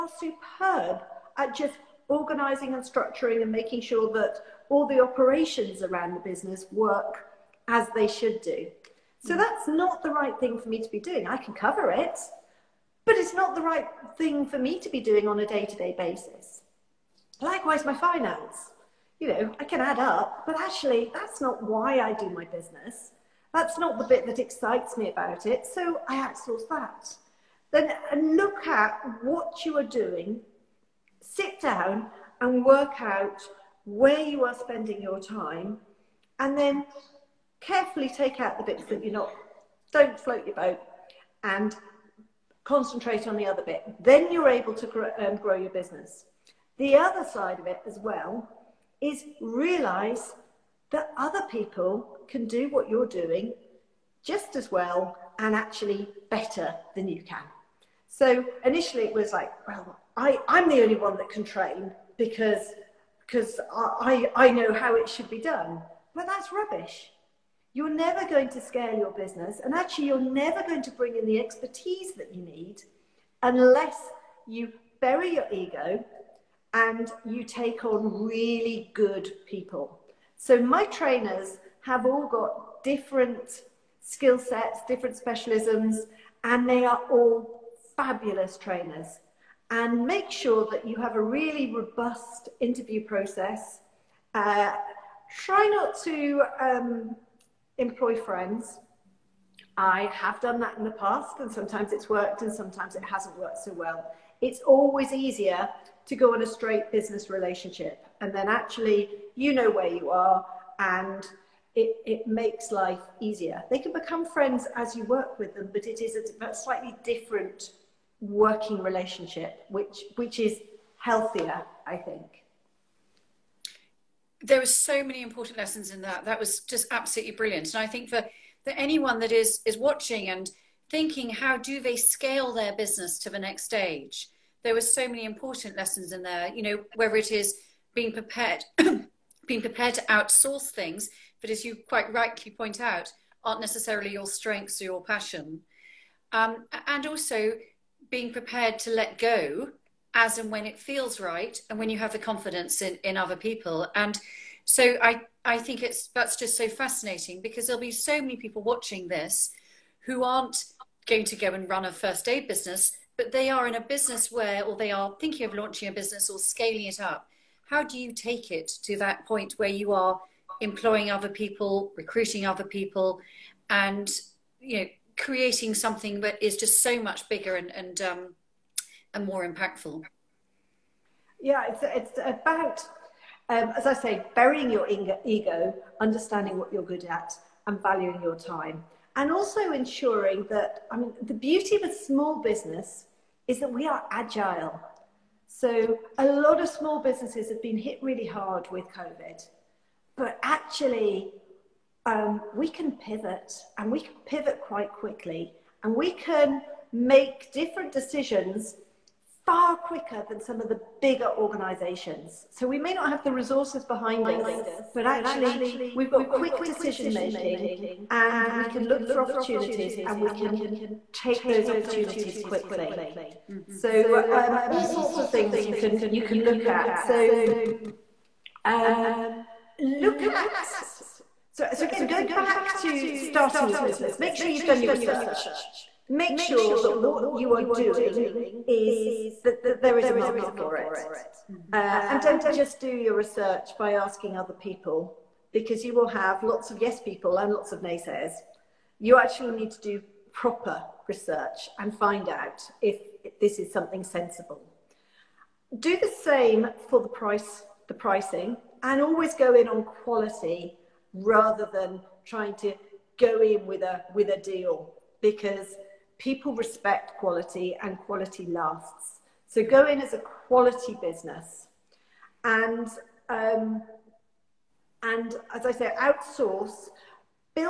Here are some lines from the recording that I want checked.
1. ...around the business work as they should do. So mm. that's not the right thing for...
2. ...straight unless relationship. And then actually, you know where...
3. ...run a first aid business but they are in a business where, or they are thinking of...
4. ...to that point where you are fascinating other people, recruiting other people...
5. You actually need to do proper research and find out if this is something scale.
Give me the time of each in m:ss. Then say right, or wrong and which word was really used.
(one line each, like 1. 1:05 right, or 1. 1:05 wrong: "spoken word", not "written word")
1. 0:05 right
2. 1:46 wrong: "business", not "unless"
3. 2:41 right
4. 2:48 wrong: "employing", not "fascinating"
5. 4:08 wrong: "sensible", not "scale".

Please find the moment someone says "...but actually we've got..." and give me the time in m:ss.
3:34.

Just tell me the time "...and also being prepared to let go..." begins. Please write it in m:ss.
2:26.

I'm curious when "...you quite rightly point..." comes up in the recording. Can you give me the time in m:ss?
2:21.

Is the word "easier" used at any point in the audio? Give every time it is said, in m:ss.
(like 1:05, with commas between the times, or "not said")
1:45, 1:53.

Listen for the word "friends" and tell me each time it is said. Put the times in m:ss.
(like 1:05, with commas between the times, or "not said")
1:38, 1:54.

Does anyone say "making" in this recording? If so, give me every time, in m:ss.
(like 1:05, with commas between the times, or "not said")
0:03, 3:37.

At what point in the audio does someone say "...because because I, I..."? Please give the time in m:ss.
1:02.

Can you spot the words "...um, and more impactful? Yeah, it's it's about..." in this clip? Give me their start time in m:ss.
2:58.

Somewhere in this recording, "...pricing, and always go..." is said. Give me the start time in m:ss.
4:17.